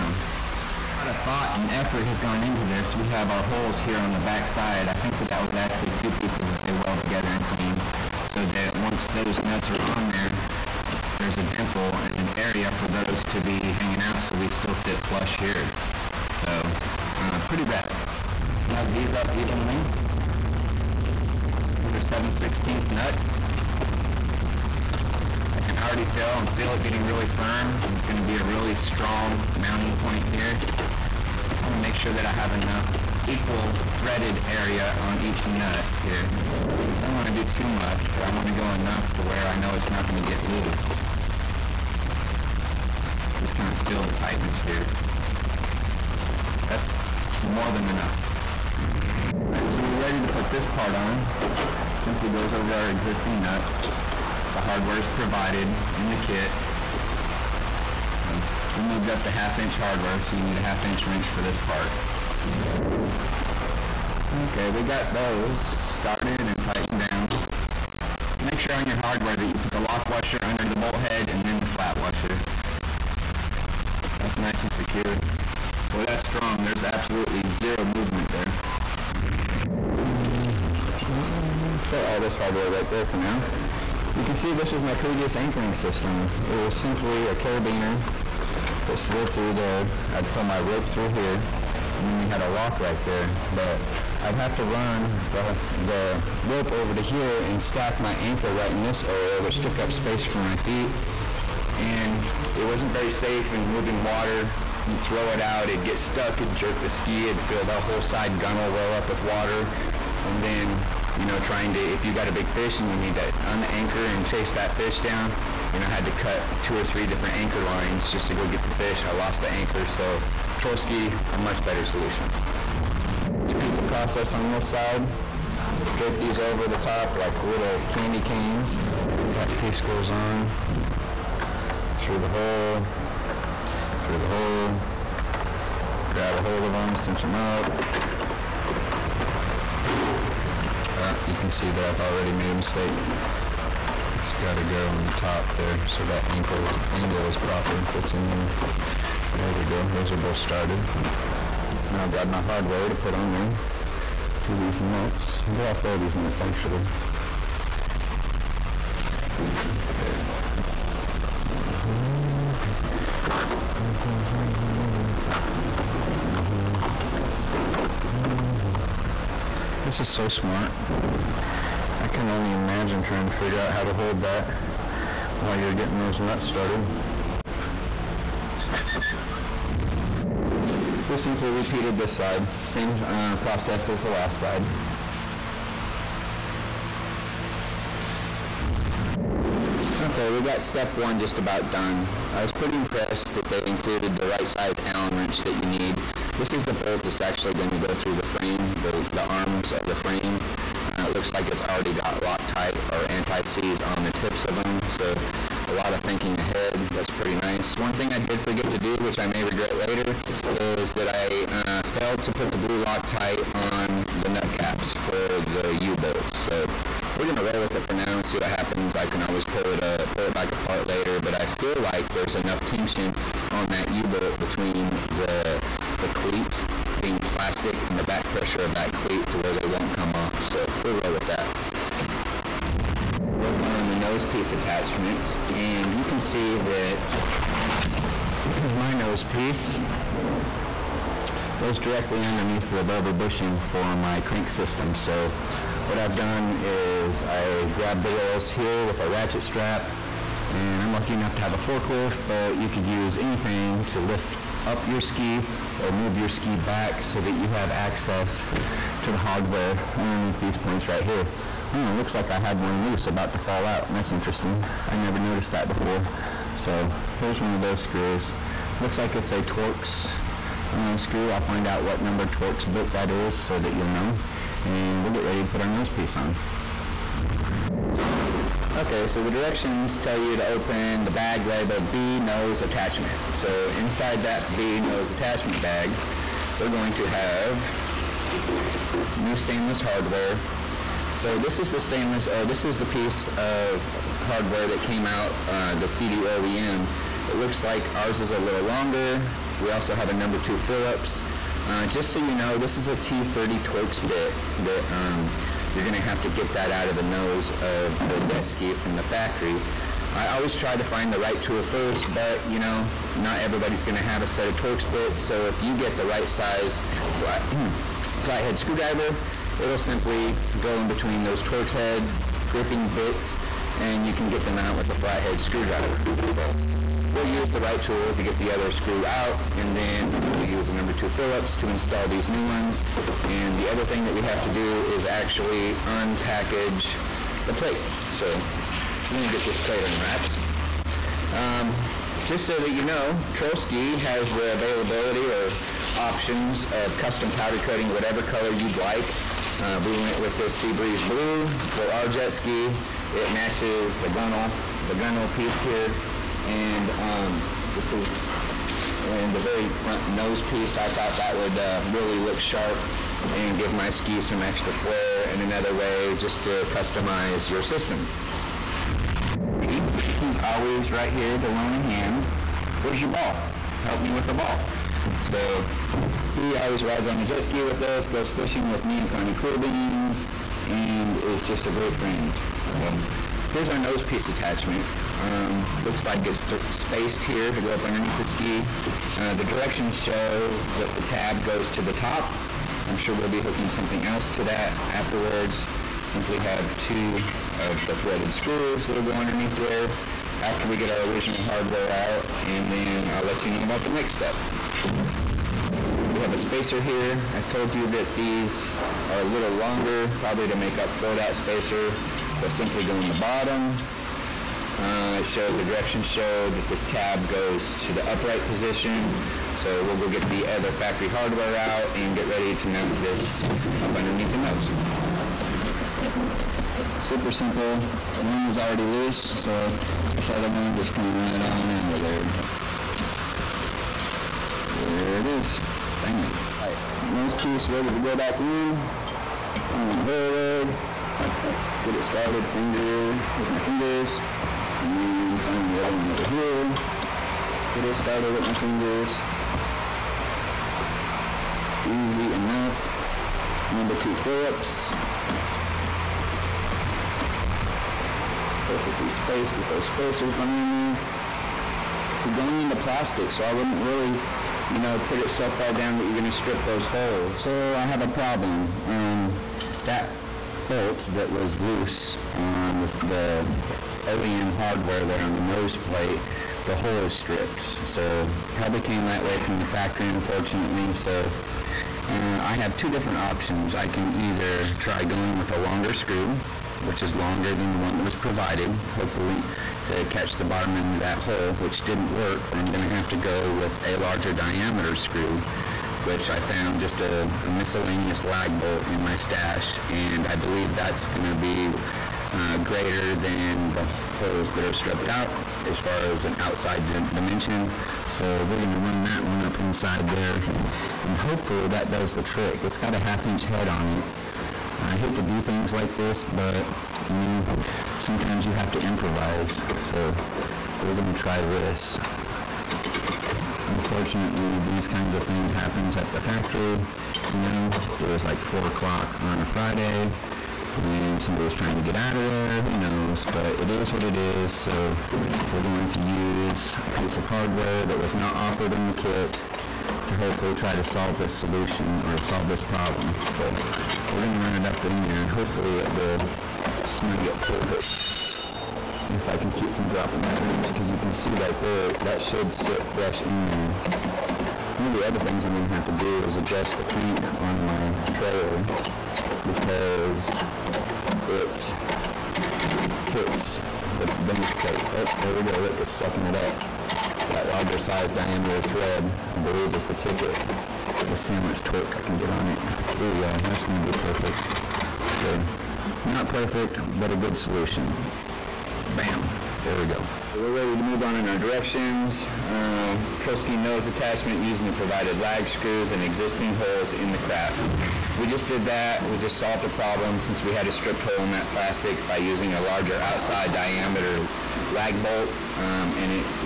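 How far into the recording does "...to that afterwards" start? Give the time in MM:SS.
06:34.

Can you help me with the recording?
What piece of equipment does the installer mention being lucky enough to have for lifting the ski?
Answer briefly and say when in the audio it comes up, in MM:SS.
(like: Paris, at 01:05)
Forklift, at 04:11.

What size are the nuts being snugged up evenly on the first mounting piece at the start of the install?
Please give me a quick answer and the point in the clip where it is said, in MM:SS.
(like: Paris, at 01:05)
7/16, at 00:21.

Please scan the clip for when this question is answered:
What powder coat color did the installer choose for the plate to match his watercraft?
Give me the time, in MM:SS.
05:50.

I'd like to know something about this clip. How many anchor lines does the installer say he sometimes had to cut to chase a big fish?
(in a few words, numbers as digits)
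2 or 3.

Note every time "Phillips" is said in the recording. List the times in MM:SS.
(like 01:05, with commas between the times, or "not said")
05:00, 05:31, 07:34.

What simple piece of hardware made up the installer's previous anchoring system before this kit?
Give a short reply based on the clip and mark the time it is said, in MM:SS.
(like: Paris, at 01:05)
Carabiner, at 01:27.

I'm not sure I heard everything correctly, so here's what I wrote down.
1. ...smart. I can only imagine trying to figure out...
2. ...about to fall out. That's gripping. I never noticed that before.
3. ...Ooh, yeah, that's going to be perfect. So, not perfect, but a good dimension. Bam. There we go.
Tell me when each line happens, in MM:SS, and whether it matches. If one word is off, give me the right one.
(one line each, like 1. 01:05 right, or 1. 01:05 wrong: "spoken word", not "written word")
1. 02:50 right
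2. 04:23 wrong: "interesting", not "gripping"
3. 09:32 wrong: "solution", not "dimension".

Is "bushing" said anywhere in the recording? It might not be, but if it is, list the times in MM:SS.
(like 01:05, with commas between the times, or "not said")
04:03.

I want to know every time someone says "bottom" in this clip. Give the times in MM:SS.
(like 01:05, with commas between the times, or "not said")
06:53, 08:10.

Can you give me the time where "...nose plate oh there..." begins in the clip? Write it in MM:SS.
09:24.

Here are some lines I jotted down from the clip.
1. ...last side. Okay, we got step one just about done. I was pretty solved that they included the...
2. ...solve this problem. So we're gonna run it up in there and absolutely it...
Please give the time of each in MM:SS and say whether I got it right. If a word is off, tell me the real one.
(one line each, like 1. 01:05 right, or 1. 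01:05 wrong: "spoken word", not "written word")
1. 03:04 wrong: "impressed", not "solved"
2. 09:02 wrong: "hopefully", not "absolutely".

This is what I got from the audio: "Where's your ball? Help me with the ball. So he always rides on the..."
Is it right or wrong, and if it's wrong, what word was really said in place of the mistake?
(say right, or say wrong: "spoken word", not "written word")
right.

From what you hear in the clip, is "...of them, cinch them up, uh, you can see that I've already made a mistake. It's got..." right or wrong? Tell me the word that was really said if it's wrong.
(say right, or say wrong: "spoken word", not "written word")
right.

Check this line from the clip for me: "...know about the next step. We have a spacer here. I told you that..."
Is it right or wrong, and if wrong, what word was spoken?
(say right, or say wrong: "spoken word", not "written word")
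right.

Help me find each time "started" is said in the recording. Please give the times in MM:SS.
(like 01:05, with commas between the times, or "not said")
01:05, 02:30, 02:56, 07:22, 07:27.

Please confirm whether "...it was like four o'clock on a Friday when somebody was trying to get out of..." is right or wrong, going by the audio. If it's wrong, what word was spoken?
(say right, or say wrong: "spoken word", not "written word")
right.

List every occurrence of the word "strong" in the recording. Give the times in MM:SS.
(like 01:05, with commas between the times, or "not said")
00:28, 01:16.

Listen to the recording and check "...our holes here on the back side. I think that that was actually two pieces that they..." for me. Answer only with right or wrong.
right.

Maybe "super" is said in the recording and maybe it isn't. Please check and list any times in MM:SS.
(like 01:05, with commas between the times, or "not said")
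07:07.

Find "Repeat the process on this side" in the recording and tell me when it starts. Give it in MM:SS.
02:03.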